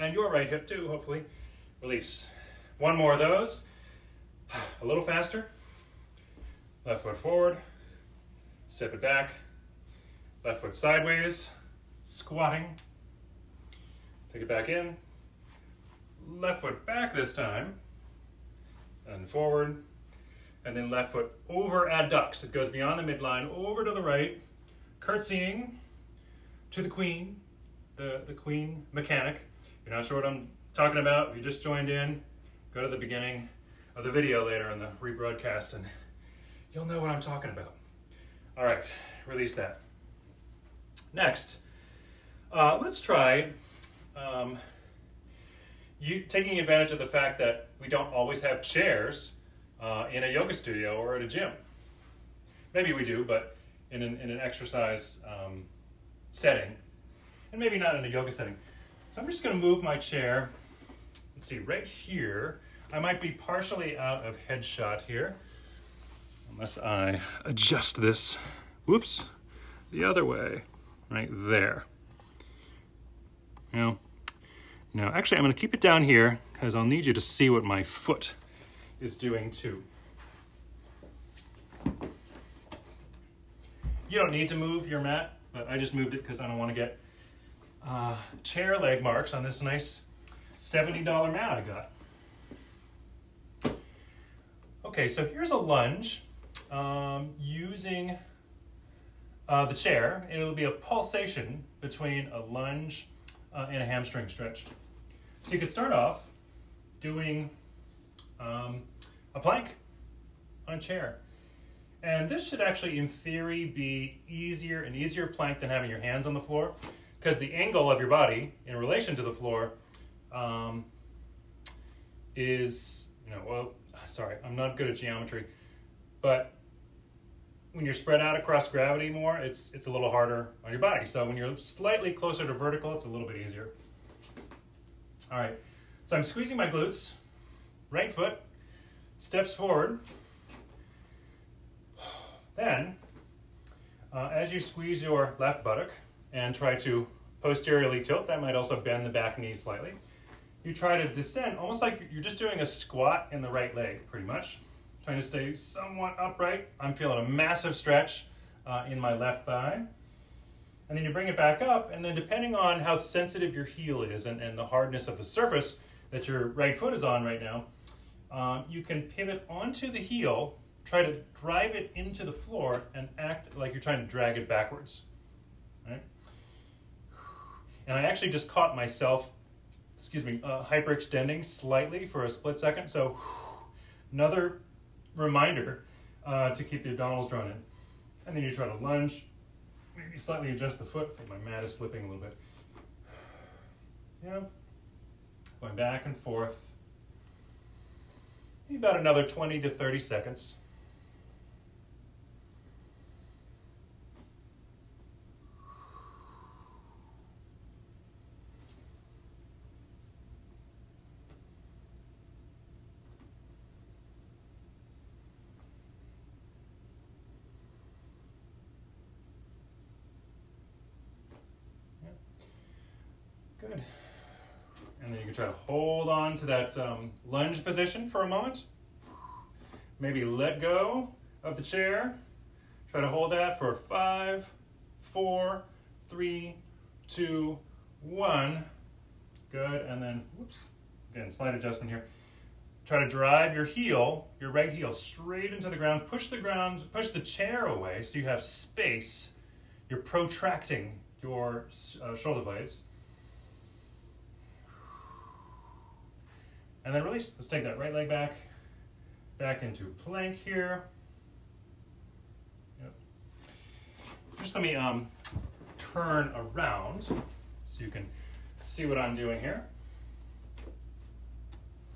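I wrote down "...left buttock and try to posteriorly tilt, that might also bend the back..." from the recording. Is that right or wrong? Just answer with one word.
right.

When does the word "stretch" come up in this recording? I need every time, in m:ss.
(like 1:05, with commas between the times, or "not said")
1:44, 2:37.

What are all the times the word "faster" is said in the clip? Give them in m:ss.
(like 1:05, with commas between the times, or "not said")
0:05.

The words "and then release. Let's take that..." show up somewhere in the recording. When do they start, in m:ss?
4:16.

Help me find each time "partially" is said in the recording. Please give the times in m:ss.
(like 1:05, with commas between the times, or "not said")
1:03.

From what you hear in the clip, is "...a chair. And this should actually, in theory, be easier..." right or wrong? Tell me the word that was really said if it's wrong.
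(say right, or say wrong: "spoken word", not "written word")
right.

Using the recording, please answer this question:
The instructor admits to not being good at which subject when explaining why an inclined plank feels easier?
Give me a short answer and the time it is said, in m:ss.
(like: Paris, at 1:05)
Geometry, at 2:04.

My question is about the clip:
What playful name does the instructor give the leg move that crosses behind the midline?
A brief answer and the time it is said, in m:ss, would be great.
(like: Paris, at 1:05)
Curtsying to the queen, at 0:24.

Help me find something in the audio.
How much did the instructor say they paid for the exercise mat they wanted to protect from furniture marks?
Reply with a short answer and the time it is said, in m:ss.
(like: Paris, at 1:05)
$70, at 1:30.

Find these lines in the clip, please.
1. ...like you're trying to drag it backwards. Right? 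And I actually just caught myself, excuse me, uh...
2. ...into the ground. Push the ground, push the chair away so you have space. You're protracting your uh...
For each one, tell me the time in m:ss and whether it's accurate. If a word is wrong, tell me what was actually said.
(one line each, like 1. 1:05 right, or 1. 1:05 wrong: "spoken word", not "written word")
1. 2:53 right
2. 4:05 right.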